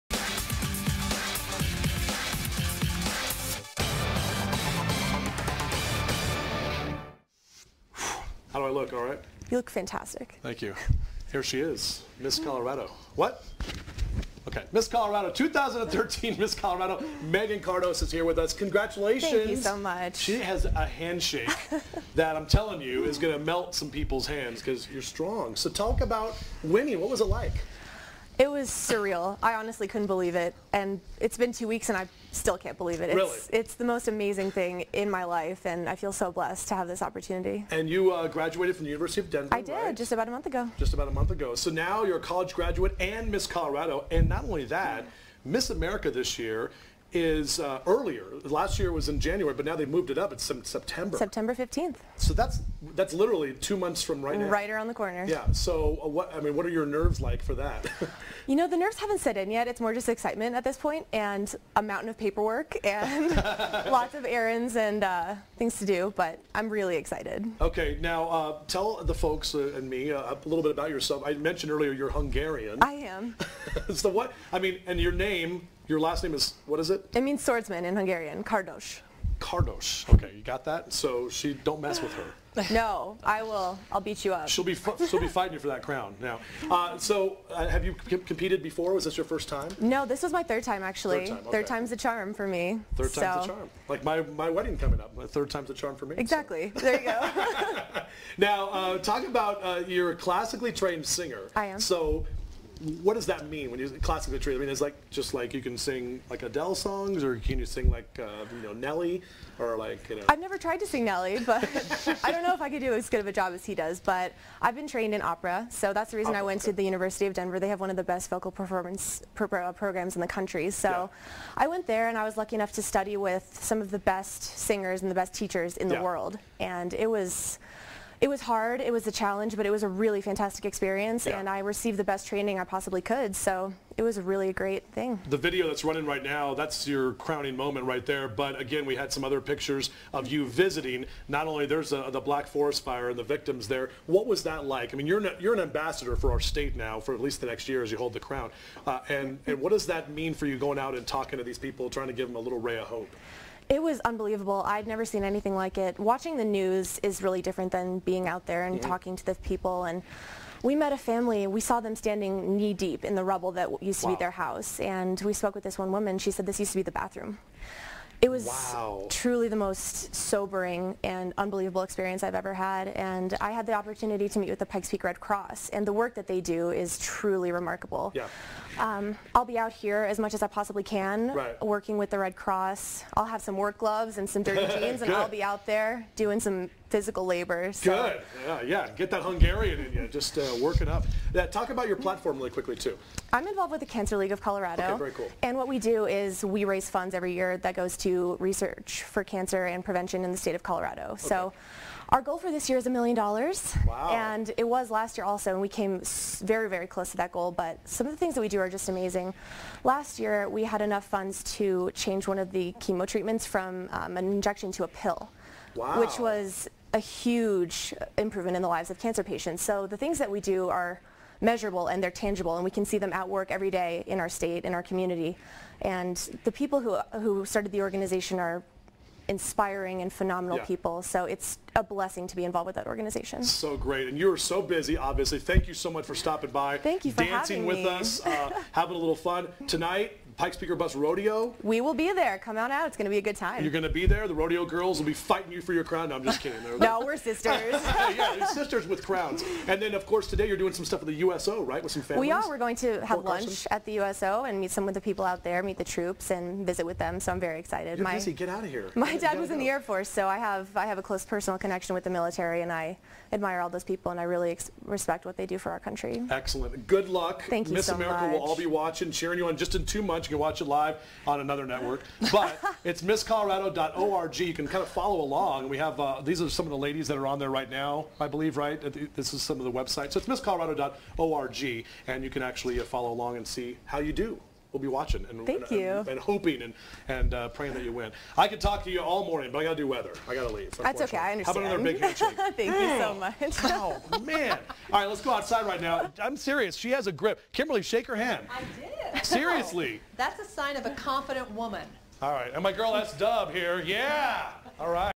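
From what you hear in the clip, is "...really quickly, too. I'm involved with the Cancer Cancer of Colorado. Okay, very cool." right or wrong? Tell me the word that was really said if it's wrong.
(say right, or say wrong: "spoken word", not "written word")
wrong: "League", not "Cancer".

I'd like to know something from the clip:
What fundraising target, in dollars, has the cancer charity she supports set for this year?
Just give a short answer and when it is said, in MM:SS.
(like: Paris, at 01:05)
$1,000,000, at 03:22.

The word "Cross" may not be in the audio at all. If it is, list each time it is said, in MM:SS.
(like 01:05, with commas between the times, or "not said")
02:55, 03:02.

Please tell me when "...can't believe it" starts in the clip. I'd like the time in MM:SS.
00:32.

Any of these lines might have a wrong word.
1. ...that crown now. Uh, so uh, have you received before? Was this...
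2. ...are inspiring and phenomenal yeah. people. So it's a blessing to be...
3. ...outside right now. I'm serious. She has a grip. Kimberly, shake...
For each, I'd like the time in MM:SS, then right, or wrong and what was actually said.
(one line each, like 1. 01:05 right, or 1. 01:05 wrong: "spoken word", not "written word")
1. 01:25 wrong: "competed", not "received"
2. 03:48 right
3. 04:55 right.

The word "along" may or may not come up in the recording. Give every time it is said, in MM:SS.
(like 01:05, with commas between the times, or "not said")
04:35, 04:43.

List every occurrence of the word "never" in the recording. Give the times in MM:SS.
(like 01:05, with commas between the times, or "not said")
01:50, 02:34.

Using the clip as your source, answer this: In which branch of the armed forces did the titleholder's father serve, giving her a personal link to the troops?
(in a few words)
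Air Force.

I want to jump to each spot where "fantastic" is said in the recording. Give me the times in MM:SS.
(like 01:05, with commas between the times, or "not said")
00:09, 02:10.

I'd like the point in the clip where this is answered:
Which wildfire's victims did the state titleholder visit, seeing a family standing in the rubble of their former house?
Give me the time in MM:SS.
02:22.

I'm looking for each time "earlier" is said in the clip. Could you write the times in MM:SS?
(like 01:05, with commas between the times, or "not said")
00:47, 01:11.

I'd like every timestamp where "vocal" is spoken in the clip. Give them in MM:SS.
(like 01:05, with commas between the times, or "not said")
01:58.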